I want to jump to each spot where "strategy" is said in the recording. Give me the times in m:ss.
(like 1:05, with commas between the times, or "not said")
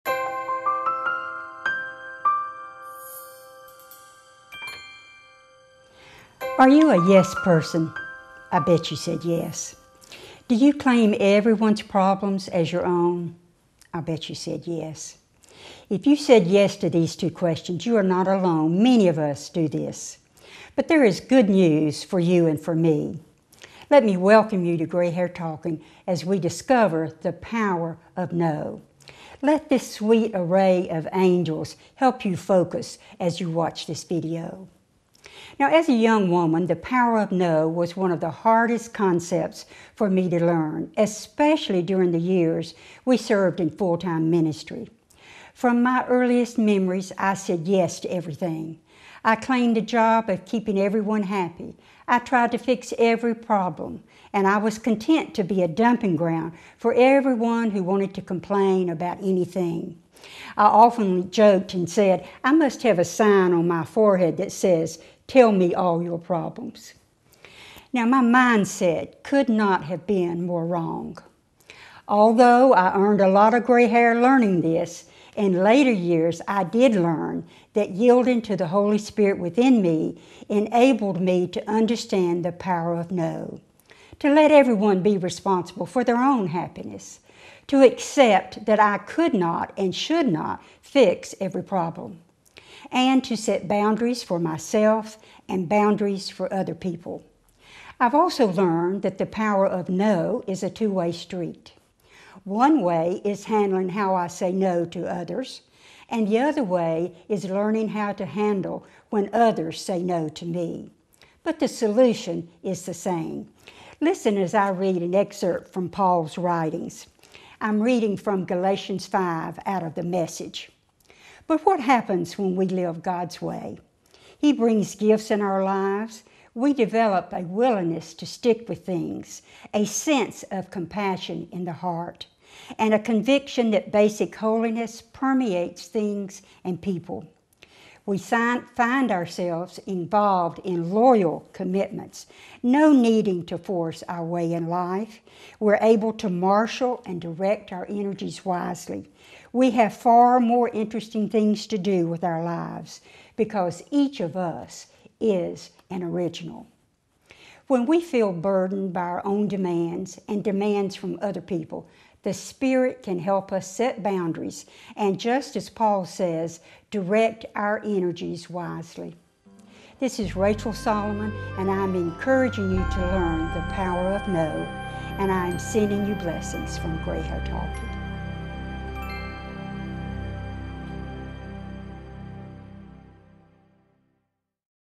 not said.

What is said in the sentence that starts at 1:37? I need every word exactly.
I've also learned that the power of no is a two way street.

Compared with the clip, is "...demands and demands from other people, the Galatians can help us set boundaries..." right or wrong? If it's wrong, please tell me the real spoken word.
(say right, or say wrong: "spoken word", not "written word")
wrong: "Spirit", not "Galatians".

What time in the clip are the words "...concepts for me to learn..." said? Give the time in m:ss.
0:38.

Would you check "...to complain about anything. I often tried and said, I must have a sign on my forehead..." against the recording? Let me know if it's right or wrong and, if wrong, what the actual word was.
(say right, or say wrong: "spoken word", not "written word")
wrong: "joked", not "tried".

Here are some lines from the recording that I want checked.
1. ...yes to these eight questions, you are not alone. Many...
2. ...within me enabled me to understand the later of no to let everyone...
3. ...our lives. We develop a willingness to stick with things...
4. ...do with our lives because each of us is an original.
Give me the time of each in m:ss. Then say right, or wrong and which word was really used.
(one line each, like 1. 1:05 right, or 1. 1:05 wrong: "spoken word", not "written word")
1. 0:16 wrong: "two", not "eight"
2. 1:19 wrong: "power", not "later"
3. 2:05 right
4. 2:31 right.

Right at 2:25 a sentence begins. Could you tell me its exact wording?
We're able to marshal and direct our energies wisely.